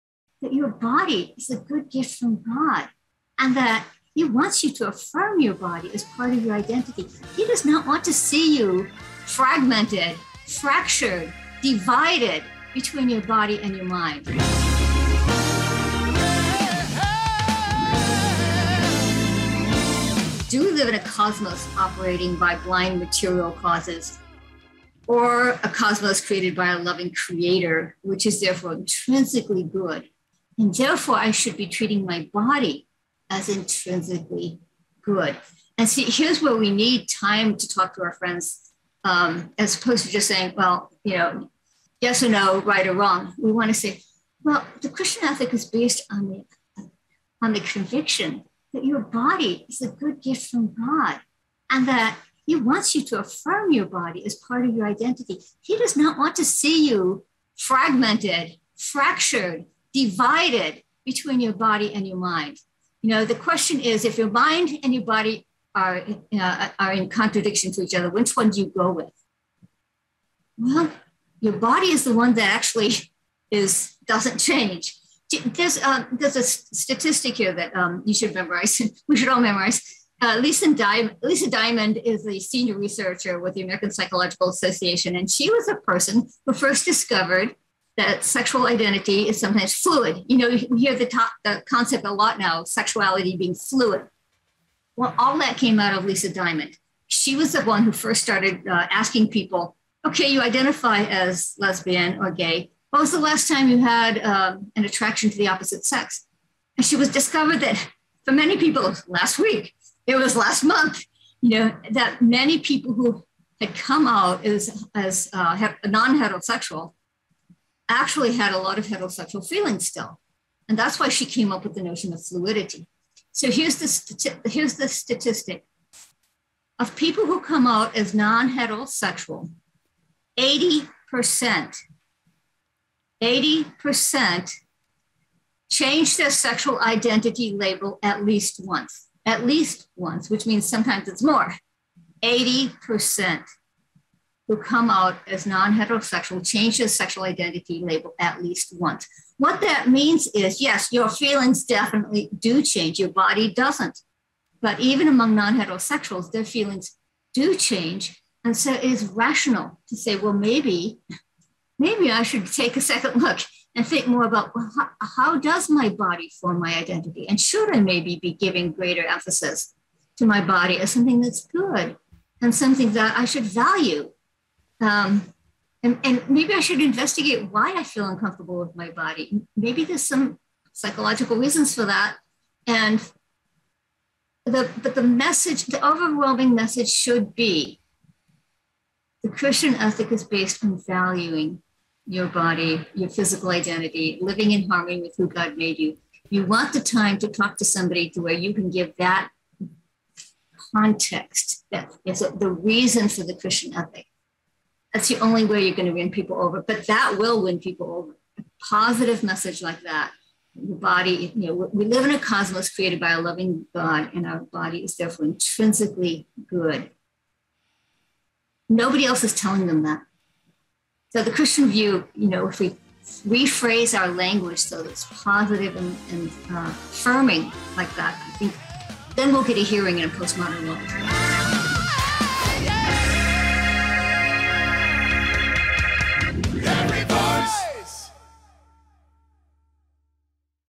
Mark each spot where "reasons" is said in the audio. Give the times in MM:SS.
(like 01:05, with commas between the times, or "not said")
03:01, 03:22.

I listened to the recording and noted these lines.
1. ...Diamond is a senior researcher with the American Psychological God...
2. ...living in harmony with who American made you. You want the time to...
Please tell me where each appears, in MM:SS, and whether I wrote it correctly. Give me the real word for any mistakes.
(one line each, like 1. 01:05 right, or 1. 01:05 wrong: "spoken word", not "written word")
1. 01:21 wrong: "Association", not "God"
2. 03:14 wrong: "God", not "American".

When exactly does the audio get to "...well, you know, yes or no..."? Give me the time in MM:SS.
00:40.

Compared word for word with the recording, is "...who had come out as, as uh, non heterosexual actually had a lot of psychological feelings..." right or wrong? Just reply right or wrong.
wrong.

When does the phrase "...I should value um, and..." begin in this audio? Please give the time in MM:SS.
02:53.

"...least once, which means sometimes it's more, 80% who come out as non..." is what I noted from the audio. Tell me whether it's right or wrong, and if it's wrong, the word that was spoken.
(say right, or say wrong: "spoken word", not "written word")
right.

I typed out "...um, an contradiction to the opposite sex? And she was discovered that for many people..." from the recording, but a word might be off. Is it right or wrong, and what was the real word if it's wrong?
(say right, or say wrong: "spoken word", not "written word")
wrong: "attraction", not "contradiction".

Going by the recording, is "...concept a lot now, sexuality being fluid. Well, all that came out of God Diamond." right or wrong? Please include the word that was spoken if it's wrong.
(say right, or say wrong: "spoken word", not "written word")
wrong: "Lisa", not "God".